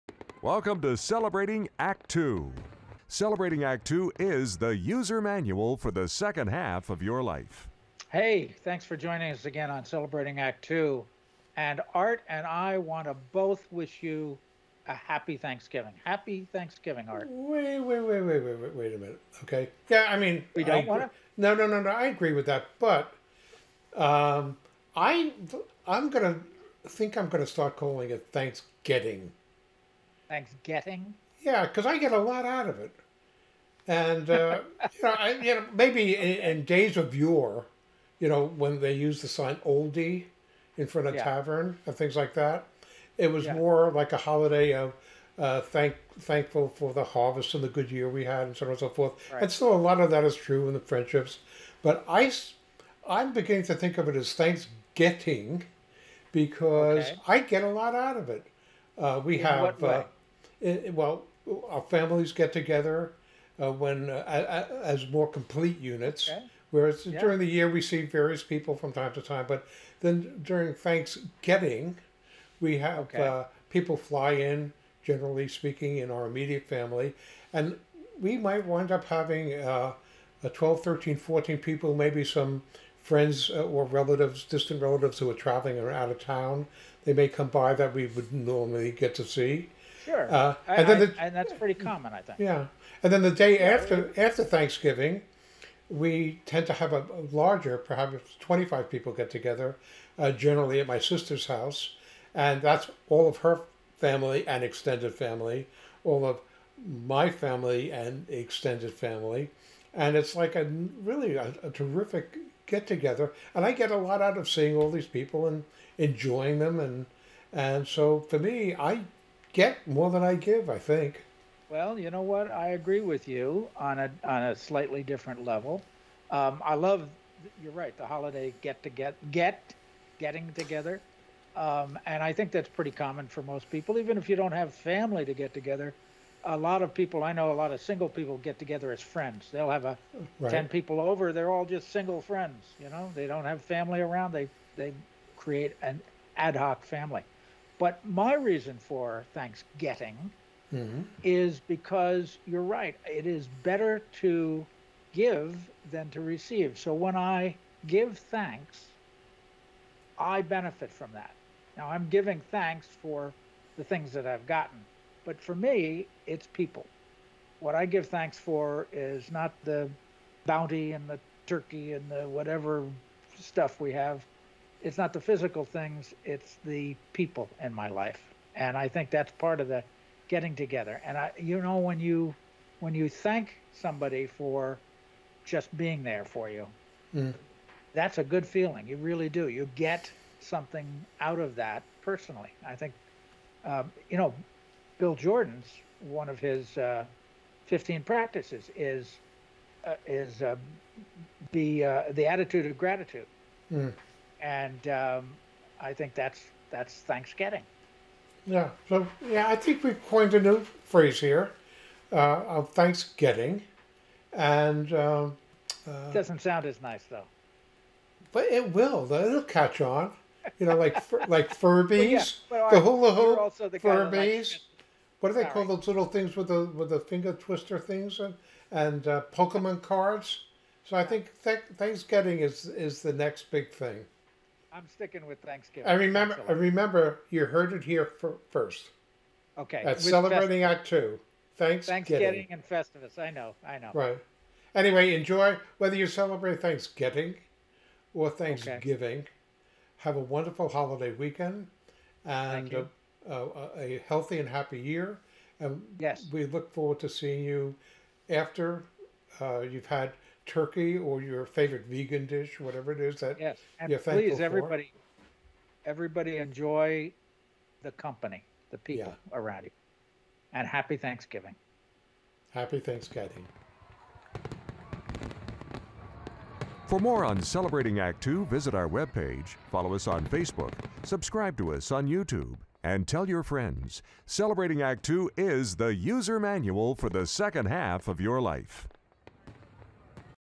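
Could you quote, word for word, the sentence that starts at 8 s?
Hey, thanks for joining us again on Celebrating Act 2.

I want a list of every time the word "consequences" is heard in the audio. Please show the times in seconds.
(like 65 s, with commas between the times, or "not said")
not said.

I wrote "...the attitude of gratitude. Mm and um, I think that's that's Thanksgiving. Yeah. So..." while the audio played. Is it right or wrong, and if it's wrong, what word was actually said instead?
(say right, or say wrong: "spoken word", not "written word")
right.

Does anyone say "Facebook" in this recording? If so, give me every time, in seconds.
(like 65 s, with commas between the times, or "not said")
280 s.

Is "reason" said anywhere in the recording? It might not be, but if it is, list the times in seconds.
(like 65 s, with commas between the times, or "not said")
148 s.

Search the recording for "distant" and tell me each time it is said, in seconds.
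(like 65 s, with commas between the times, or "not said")
84 s.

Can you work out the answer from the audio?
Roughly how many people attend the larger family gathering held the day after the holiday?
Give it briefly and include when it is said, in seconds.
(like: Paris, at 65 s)
25, at 98 s.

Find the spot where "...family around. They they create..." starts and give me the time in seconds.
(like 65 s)
143 s.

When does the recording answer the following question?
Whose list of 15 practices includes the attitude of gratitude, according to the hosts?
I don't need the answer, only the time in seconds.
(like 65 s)
194 s.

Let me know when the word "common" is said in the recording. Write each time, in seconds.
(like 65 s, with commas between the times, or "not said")
91 s, 132 s.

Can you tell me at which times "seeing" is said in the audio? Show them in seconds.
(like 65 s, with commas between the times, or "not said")
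114 s, 257 s.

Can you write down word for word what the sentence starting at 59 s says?
Uh, it, well, our families get together uh, when uh, as more complete units.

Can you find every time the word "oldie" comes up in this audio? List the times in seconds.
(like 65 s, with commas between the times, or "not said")
39 s.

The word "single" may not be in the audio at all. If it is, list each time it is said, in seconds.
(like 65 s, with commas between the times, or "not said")
137 s, 141 s.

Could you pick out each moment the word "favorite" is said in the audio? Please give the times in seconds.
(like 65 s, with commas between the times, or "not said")
261 s.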